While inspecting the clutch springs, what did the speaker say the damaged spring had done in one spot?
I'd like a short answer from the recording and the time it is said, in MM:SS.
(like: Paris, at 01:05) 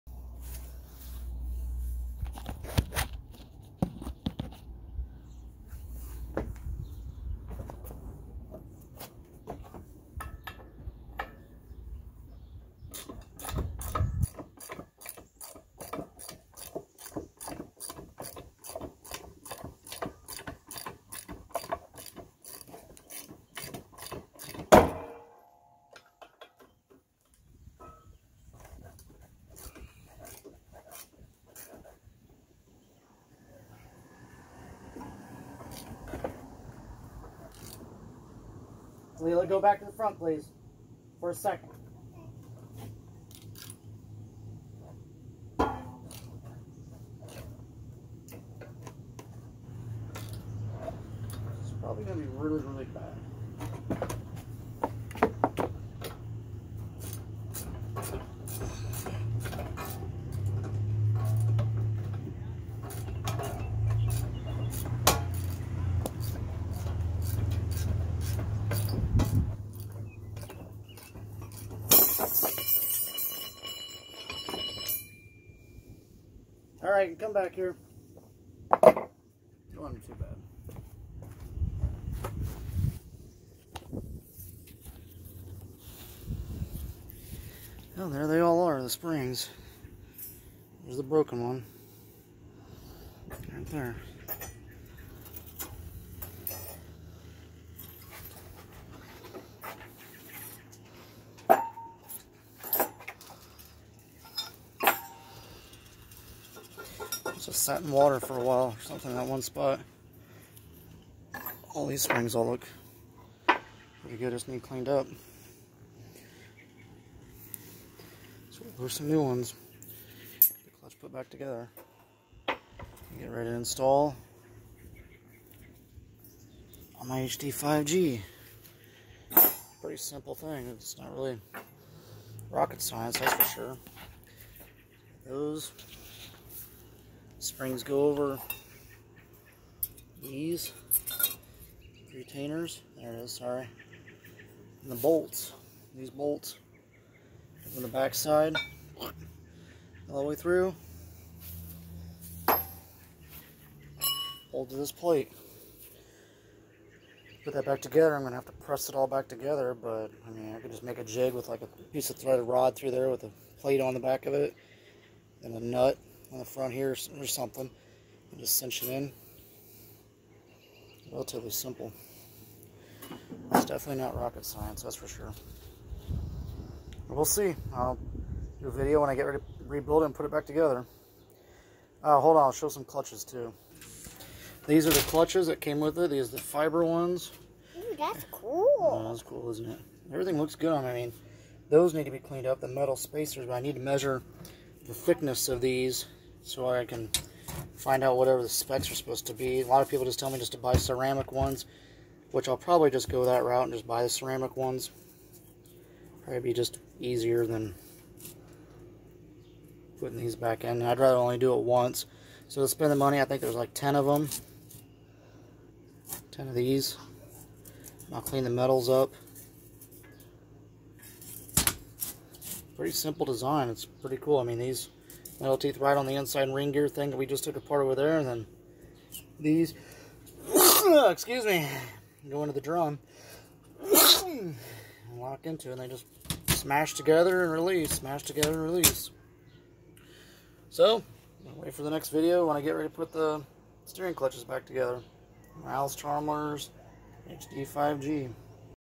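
sat in water, at 01:47.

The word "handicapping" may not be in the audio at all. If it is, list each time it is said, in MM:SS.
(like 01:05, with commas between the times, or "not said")
not said.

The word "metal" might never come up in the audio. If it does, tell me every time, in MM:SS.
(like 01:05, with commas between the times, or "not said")
03:12, 03:38, 03:45.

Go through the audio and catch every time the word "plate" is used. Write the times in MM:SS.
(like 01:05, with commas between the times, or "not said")
02:34, 02:43.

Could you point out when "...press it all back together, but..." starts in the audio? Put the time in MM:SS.
02:38.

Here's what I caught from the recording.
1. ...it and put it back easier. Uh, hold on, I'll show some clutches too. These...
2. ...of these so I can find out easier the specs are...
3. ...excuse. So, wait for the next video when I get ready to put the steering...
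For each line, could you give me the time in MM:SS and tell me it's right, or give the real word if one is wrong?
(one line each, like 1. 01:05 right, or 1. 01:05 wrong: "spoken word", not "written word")
1. 03:00 wrong: "together", not "easier"
2. 03:15 wrong: "whatever", not "easier"
3. 03:58 wrong: "release", not "excuse".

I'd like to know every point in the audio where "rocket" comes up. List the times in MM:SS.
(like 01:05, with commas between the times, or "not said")
02:12, 02:54.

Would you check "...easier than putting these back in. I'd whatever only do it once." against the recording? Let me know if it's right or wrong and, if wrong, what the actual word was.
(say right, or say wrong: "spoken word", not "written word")
wrong: "rather", not "whatever".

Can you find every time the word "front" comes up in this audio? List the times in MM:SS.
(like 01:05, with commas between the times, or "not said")
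00:39, 02:46.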